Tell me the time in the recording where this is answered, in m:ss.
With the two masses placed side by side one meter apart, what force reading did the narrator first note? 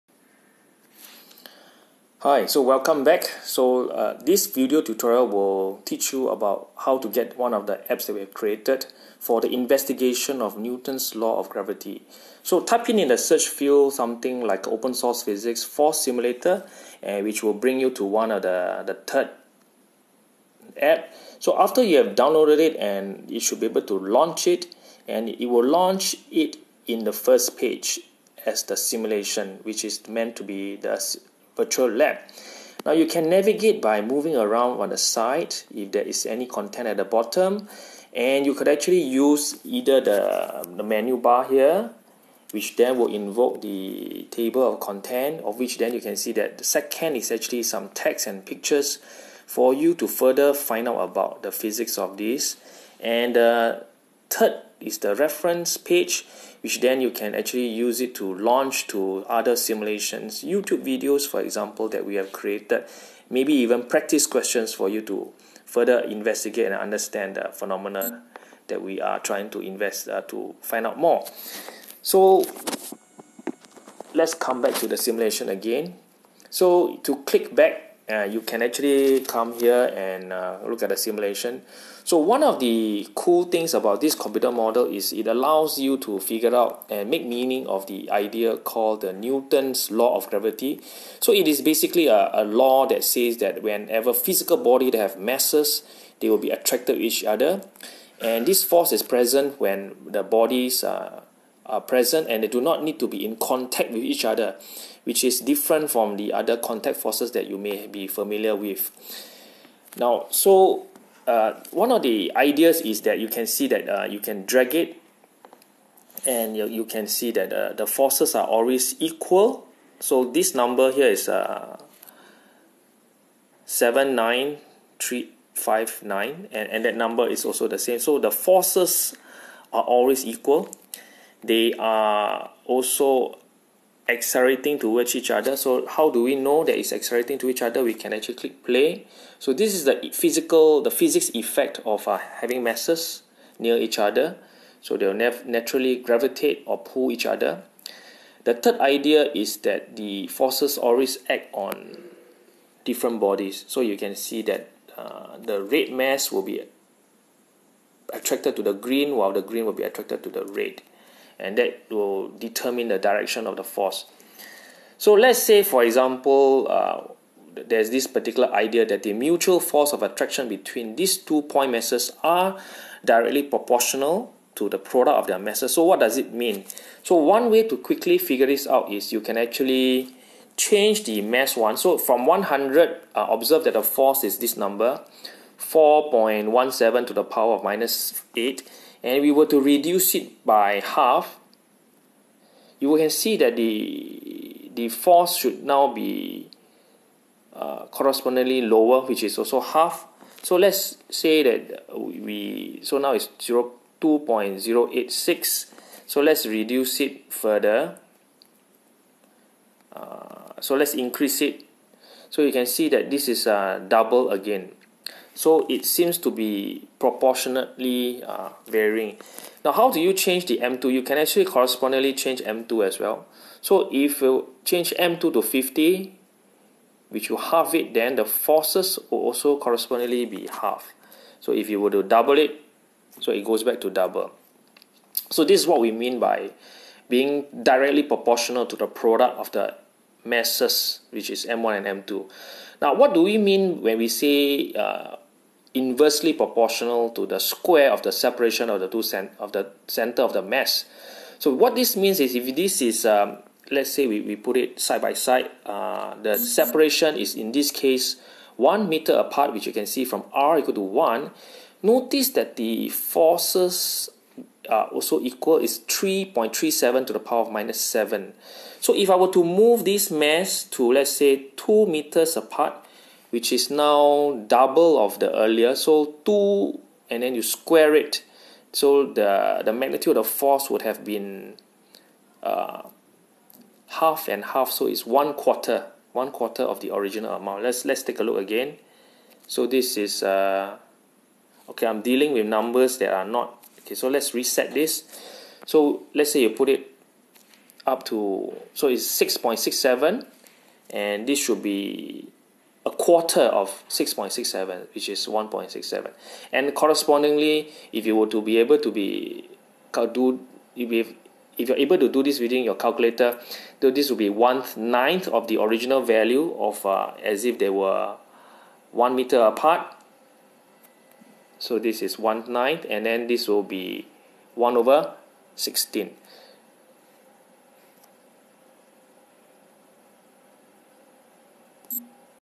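4:25.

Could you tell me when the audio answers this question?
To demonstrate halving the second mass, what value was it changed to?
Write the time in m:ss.
3:45.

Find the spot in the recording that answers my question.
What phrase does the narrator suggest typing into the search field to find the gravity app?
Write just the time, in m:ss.
0:14.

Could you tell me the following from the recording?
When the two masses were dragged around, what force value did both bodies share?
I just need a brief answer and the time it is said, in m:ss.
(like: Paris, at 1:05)
79359, at 2:03.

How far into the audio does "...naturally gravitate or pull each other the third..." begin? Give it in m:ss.
2:25.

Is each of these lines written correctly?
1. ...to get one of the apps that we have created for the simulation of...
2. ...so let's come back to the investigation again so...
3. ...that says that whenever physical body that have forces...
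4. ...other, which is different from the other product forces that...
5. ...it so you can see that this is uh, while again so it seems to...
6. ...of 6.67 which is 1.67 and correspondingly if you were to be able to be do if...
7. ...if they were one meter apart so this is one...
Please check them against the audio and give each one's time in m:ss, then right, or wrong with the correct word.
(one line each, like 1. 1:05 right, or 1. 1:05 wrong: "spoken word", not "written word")
1. 0:06 wrong: "investigation", not "simulation"
2. 1:12 wrong: "simulation", not "investigation"
3. 1:32 wrong: "masses", not "forces"
4. 1:44 wrong: "contact", not "product"
5. 3:31 wrong: "double", not "while"
6. 5:03 right
7. 5:17 right.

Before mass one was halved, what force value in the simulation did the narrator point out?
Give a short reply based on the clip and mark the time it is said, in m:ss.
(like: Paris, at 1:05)
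4.17 x 10^-8, at 3:05.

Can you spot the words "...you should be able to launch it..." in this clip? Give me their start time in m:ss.
0:23.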